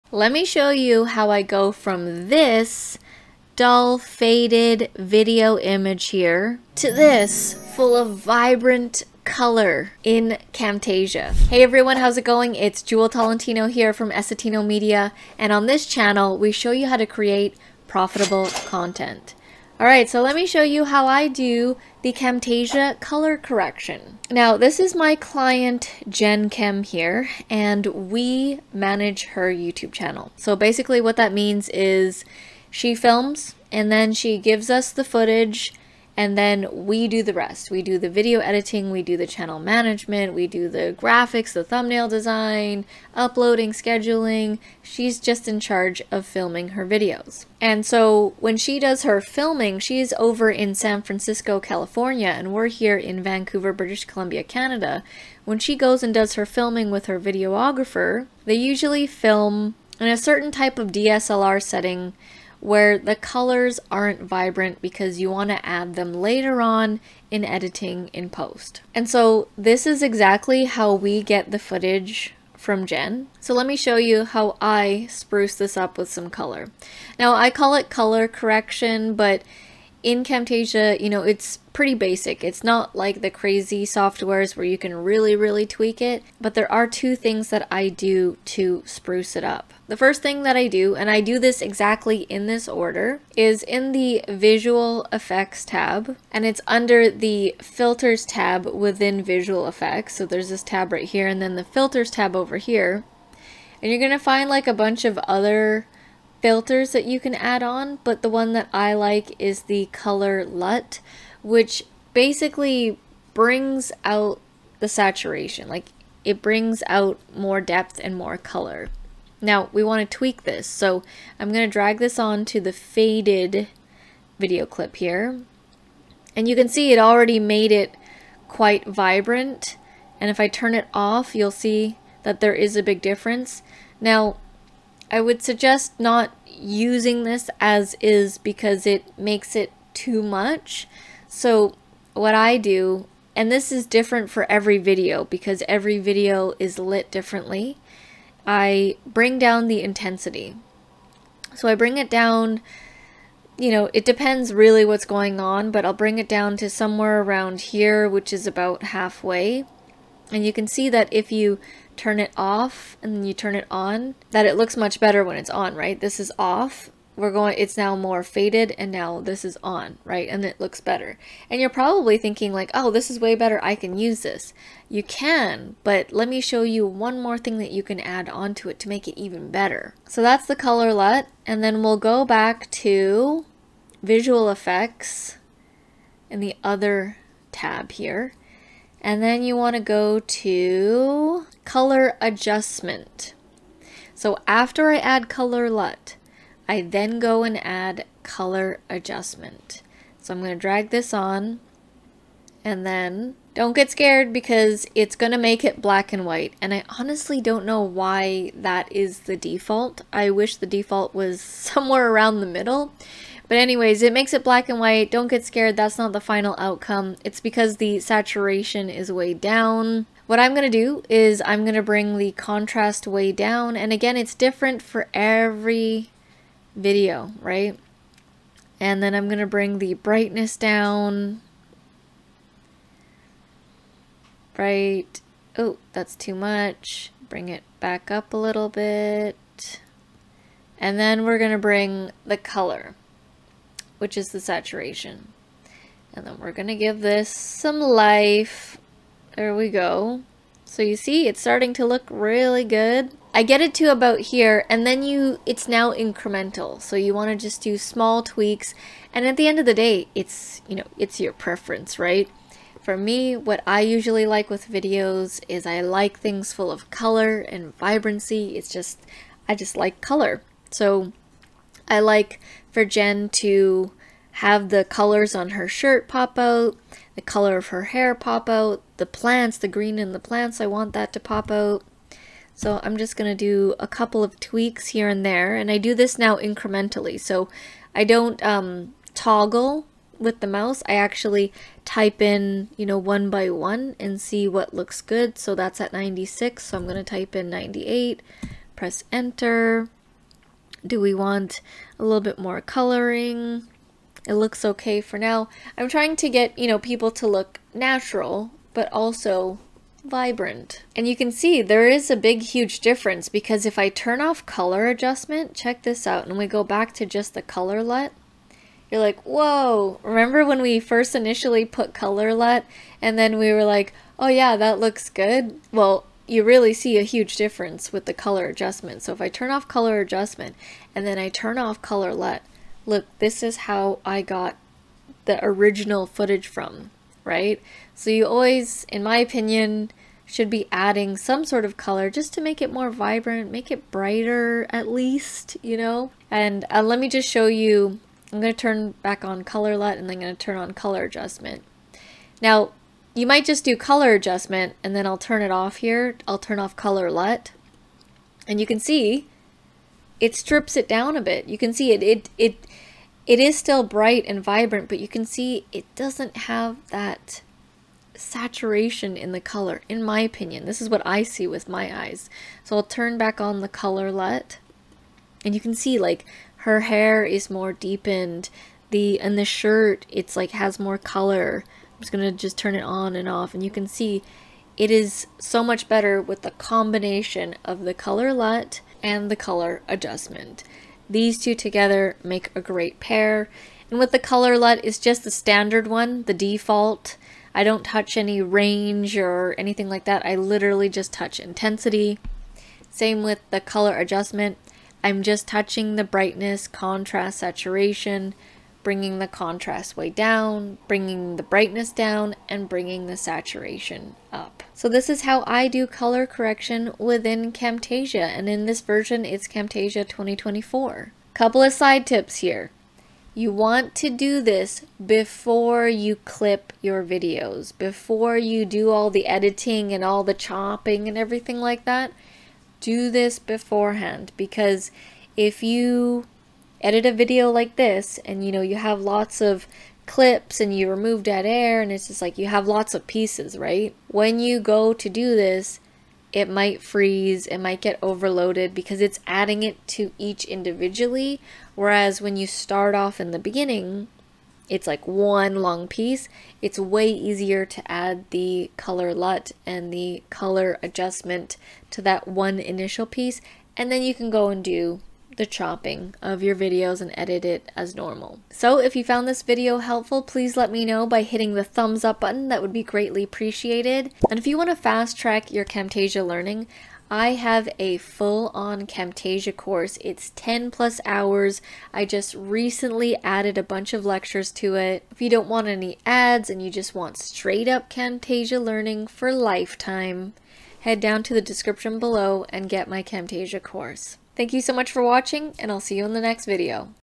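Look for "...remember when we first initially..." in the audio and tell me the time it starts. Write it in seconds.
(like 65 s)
320 s.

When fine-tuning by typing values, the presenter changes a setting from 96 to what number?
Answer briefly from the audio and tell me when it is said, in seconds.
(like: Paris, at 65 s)
98, at 297 s.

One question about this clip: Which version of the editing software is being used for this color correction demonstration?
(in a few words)
Camtasia 2024.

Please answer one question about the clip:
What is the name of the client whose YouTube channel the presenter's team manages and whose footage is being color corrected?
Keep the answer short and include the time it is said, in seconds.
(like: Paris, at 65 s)
Jen Kim, at 26 s.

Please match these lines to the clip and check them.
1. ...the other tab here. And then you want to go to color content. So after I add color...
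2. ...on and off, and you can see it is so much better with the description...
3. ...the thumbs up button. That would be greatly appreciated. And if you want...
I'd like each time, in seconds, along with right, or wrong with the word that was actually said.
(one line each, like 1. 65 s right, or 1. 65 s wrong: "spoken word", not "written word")
1. 186 s wrong: "adjustment", not "content"
2. 382 s wrong: "combination", not "description"
3. 471 s right.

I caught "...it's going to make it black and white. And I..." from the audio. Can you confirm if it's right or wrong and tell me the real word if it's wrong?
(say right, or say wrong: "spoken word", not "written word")
right.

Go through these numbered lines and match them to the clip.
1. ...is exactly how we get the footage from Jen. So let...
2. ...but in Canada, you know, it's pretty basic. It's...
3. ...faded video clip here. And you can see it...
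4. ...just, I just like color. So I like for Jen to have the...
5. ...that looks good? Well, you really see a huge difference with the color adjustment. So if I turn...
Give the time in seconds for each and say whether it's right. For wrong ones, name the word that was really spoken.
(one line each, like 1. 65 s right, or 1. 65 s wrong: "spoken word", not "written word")
1. 69 s right
2. 79 s wrong: "Camtasia", not "Canada"
3. 122 s right
4. 268 s right
5. 324 s right.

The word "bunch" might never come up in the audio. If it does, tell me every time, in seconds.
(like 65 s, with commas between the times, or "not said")
104 s, 483 s.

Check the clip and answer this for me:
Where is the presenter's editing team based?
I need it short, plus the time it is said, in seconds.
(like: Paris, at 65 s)
Vancouver, British Columbia, at 53 s.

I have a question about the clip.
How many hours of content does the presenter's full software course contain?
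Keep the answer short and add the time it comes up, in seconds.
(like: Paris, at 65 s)
10 plus hours, at 480 s.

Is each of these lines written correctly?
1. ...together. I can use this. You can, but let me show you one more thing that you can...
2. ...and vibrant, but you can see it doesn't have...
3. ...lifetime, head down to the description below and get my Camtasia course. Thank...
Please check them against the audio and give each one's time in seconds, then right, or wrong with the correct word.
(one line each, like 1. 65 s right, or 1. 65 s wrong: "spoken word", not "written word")
1. 173 s wrong: "better", not "together"
2. 364 s right
3. 489 s right.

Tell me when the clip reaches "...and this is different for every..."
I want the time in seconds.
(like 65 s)
143 s.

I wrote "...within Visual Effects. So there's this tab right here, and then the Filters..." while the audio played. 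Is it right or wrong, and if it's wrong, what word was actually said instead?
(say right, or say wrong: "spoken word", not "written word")
right.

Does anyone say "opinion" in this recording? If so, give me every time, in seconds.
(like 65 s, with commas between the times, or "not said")
339 s, 370 s.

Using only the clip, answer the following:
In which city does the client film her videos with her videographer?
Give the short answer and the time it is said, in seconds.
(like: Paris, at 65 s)
San Francisco, at 50 s.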